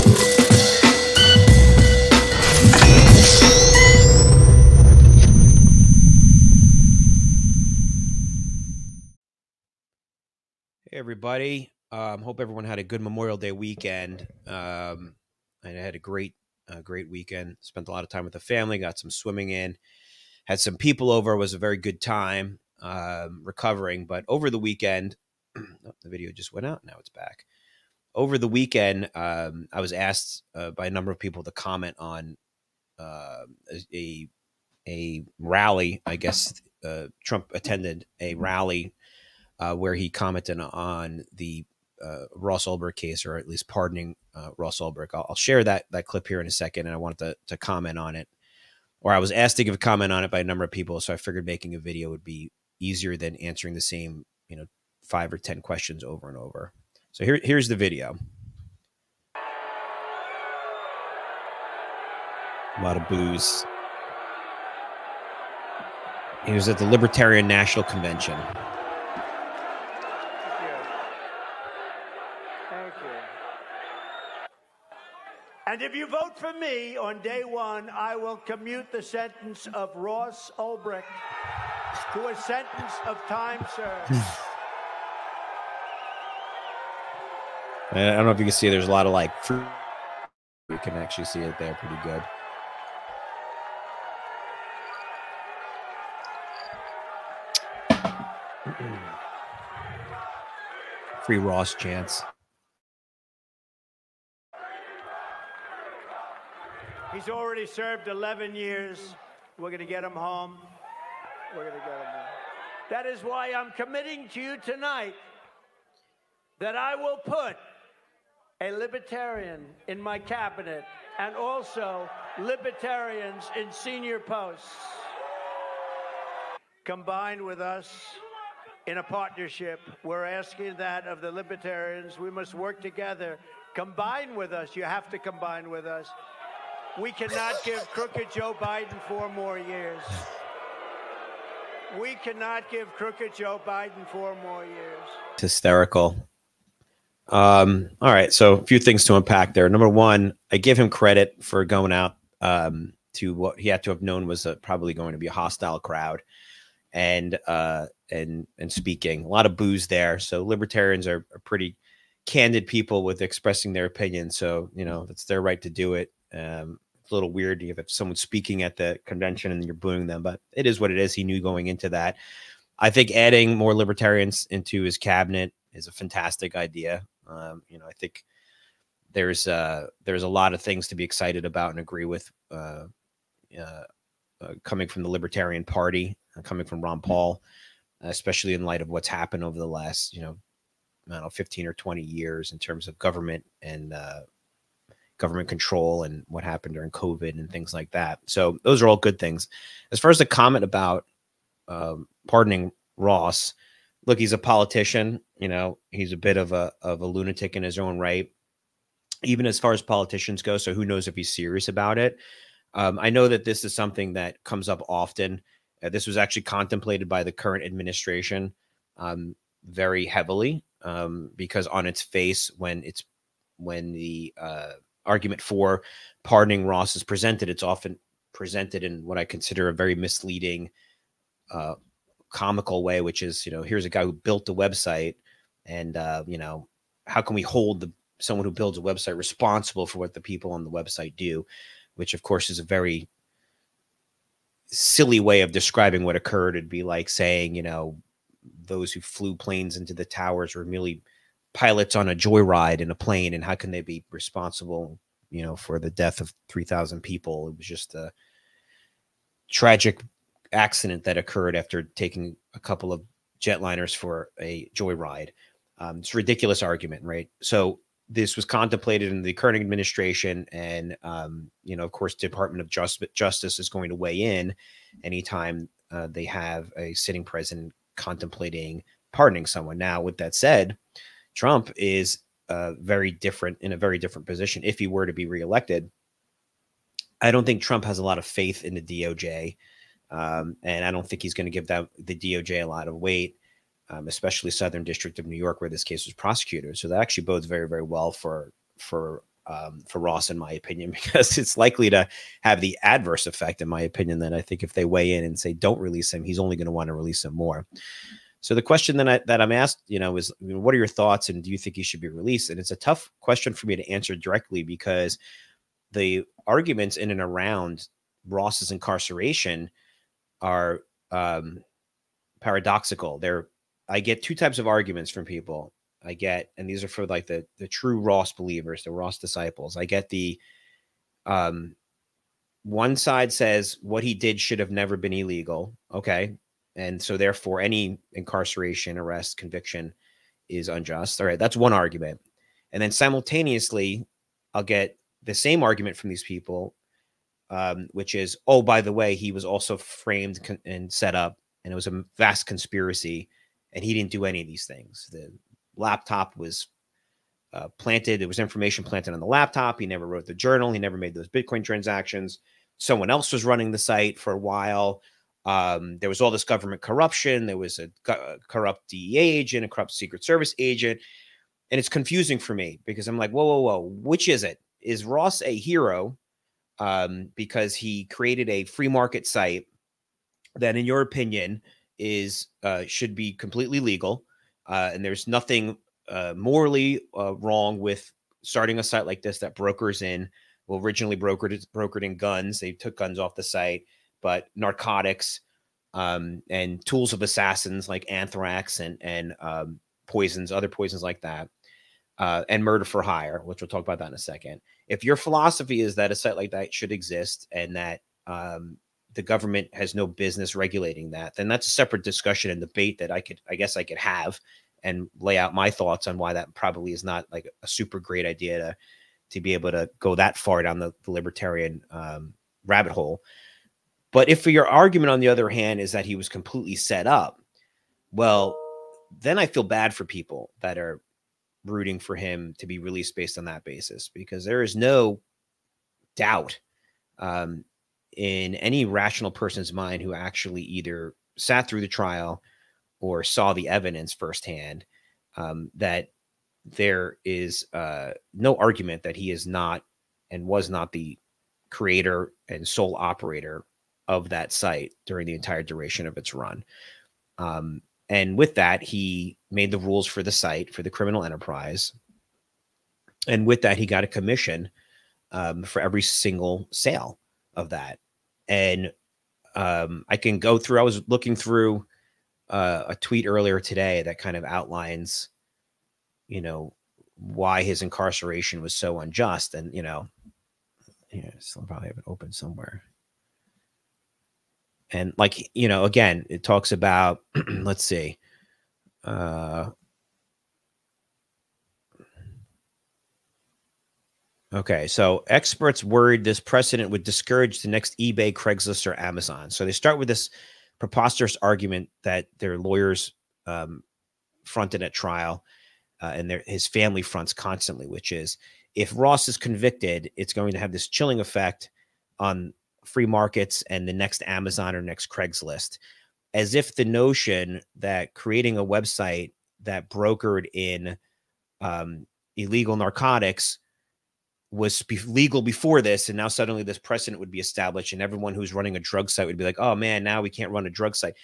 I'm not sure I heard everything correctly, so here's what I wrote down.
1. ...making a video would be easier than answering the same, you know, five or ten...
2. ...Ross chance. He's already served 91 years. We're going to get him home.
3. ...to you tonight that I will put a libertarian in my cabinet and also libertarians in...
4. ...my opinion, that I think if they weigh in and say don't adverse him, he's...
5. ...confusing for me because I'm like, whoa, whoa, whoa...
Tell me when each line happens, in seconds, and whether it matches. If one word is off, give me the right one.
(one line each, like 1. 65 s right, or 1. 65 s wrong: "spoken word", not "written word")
1. 51 s right
2. 101 s wrong: "11", not "91"
3. 114 s right
4. 303 s wrong: "release", not "adverse"
5. 371 s right.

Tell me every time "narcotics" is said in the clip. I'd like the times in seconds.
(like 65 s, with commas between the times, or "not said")
394 s, 522 s.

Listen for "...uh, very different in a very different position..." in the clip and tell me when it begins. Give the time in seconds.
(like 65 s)
282 s.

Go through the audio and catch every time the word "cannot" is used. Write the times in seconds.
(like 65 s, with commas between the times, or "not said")
137 s, 142 s.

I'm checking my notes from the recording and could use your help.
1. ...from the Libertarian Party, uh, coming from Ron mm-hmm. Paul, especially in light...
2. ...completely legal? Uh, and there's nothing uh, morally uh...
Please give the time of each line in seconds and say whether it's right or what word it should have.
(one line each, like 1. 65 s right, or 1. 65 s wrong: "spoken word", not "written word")
1. 184 s right
2. 383 s right.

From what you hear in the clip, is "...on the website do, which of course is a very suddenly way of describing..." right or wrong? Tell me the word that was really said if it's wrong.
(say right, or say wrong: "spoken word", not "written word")
wrong: "silly", not "suddenly".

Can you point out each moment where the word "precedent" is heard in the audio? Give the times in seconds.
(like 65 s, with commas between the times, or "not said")
496 s, 526 s.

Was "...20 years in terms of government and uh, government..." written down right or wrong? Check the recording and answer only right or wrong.
right.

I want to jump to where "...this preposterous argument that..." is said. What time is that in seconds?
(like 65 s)
500 s.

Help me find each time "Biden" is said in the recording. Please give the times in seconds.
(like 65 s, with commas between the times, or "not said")
138 s, 143 s.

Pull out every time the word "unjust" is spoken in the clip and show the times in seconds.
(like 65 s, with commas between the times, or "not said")
340 s, 479 s.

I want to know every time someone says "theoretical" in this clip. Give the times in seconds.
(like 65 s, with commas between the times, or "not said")
not said.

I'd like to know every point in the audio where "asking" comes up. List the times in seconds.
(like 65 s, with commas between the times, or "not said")
130 s.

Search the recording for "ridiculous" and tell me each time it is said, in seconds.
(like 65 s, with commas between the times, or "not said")
266 s.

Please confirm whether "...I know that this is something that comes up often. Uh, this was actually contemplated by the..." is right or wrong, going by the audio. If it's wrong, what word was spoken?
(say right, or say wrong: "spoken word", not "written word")
right.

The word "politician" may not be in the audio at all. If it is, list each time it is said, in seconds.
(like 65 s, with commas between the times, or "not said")
204 s, 209 s.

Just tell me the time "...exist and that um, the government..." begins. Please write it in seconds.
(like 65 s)
406 s.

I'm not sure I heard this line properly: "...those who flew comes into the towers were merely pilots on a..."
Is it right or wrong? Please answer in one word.
wrong.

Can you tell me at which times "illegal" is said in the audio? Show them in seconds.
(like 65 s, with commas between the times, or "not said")
335 s, 522 s.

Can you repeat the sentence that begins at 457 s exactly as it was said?
Um, and with that, he made the rules for the site for the criminal enterprise.